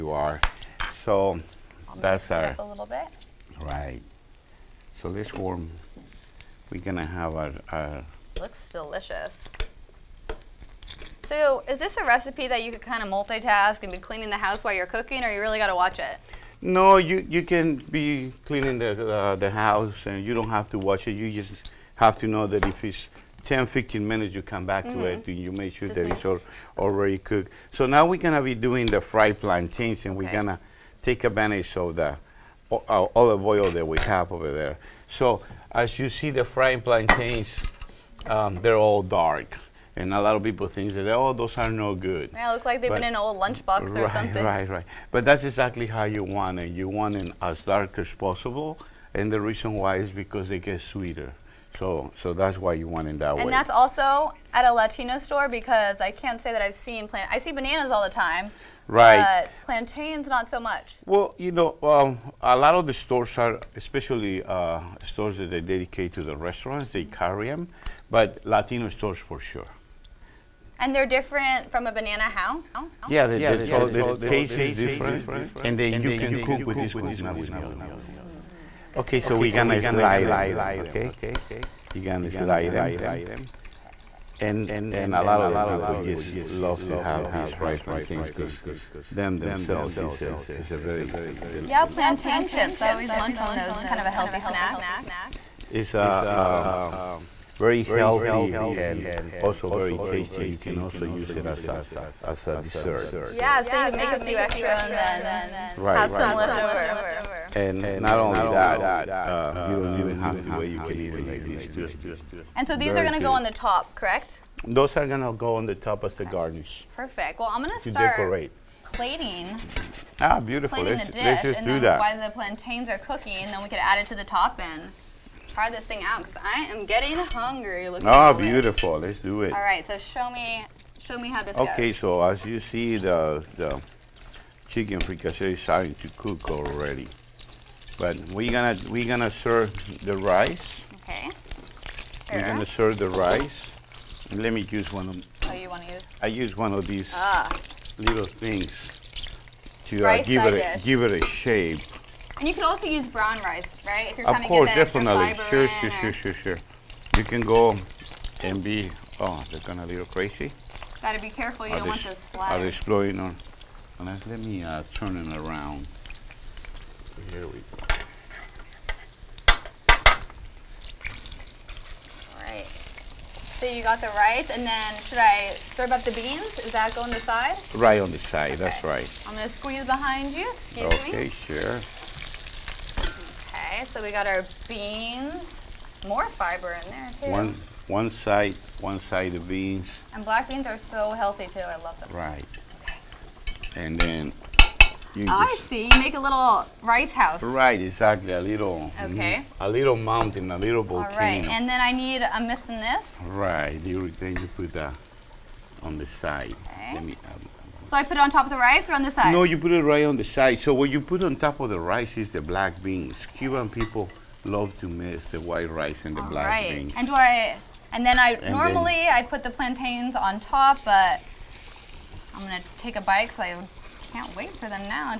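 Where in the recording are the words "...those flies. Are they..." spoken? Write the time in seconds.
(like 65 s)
162 s.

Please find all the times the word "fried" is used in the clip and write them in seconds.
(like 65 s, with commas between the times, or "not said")
29 s, 36 s, 87 s.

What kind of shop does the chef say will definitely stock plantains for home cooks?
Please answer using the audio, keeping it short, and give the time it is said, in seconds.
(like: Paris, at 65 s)
Latino stores, at 68 s.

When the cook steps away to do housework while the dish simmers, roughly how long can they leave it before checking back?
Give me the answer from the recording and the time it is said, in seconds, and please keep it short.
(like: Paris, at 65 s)
10-15 minutes, at 23 s.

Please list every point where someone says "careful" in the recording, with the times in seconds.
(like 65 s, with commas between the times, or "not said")
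161 s.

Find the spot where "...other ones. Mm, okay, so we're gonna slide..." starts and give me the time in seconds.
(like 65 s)
77 s.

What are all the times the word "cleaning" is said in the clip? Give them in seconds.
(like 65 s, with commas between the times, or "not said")
13 s, 18 s.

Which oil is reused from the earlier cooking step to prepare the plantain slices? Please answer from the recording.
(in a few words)
olive oil.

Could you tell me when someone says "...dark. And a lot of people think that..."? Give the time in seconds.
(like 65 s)
39 s.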